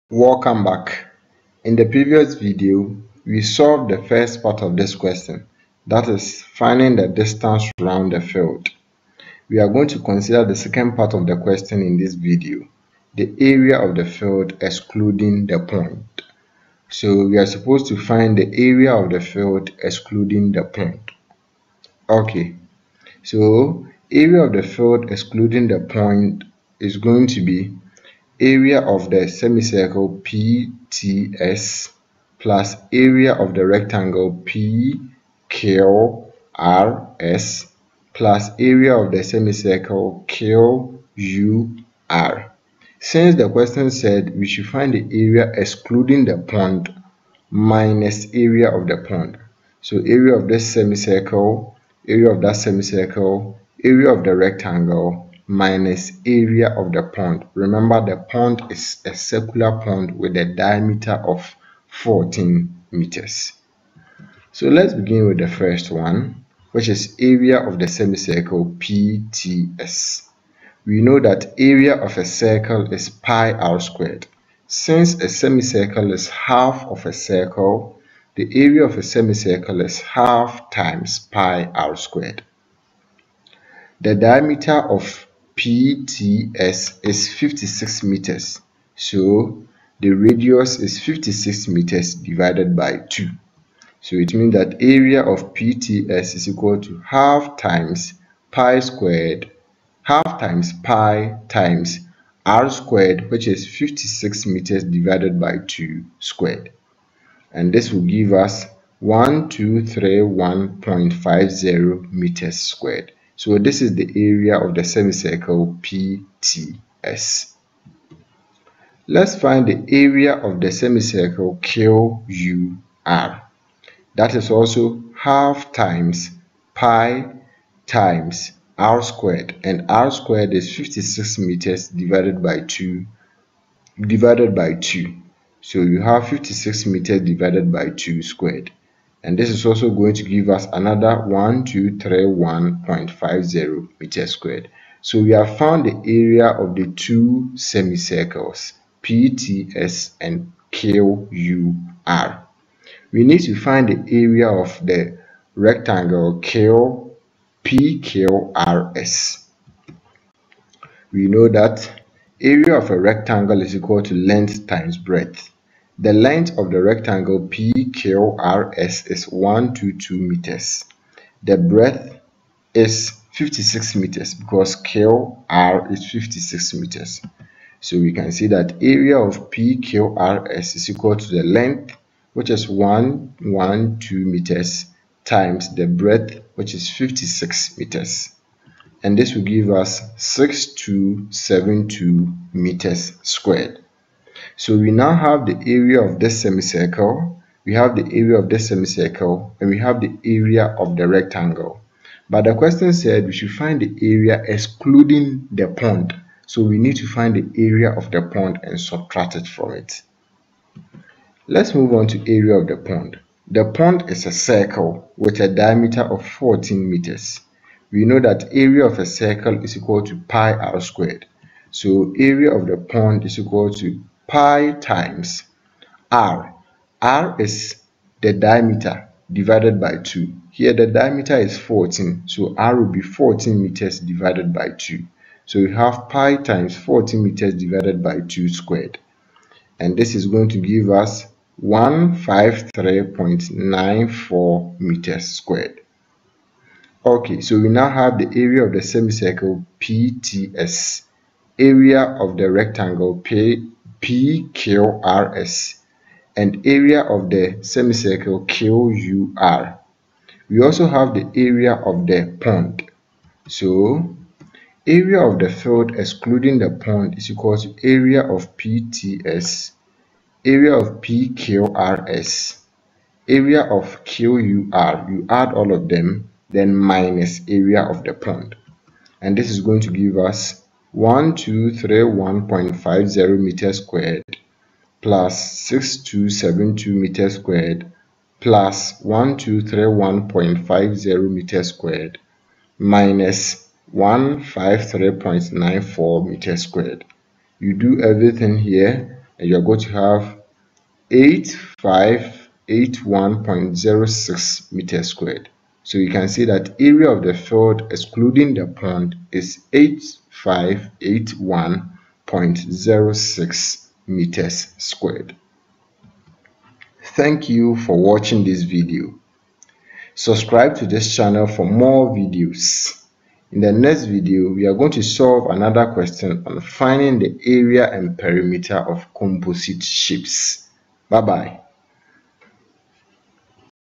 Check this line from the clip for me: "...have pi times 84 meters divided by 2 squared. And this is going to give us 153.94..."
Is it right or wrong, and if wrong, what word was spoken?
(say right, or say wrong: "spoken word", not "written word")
wrong: "14", not "84".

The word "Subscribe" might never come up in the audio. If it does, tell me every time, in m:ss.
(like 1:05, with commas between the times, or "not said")
5:20.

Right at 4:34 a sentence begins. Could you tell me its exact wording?
You add all of them, then minus area of the pond.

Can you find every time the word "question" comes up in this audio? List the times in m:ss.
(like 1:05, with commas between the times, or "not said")
0:04, 0:11, 0:43, 3:22, 5:25.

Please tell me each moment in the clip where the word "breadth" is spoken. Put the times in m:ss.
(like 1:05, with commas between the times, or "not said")
2:44, 2:51, 3:05.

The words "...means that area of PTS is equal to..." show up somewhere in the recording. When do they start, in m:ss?
1:34.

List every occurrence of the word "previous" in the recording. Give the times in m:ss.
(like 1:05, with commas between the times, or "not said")
0:01.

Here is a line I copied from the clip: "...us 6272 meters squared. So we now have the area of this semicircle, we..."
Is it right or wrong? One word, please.
right.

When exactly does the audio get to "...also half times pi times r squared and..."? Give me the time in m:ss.
2:04.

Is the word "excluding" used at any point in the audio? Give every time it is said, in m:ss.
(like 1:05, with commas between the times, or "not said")
0:14, 0:19, 0:25, 0:45, 3:24, 4:25, 5:07.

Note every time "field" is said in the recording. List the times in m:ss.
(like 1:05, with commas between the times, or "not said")
0:08, 0:14, 0:19, 0:24, 4:25, 5:07.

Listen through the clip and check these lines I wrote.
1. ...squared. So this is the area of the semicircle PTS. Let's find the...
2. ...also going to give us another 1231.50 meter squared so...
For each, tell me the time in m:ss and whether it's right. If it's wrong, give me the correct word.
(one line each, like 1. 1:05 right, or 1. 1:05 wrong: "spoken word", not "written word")
1. 1:52 right
2. 2:19 right.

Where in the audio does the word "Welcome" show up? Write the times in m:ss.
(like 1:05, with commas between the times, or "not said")
0:00.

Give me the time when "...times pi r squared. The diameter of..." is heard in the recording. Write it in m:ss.
1:20.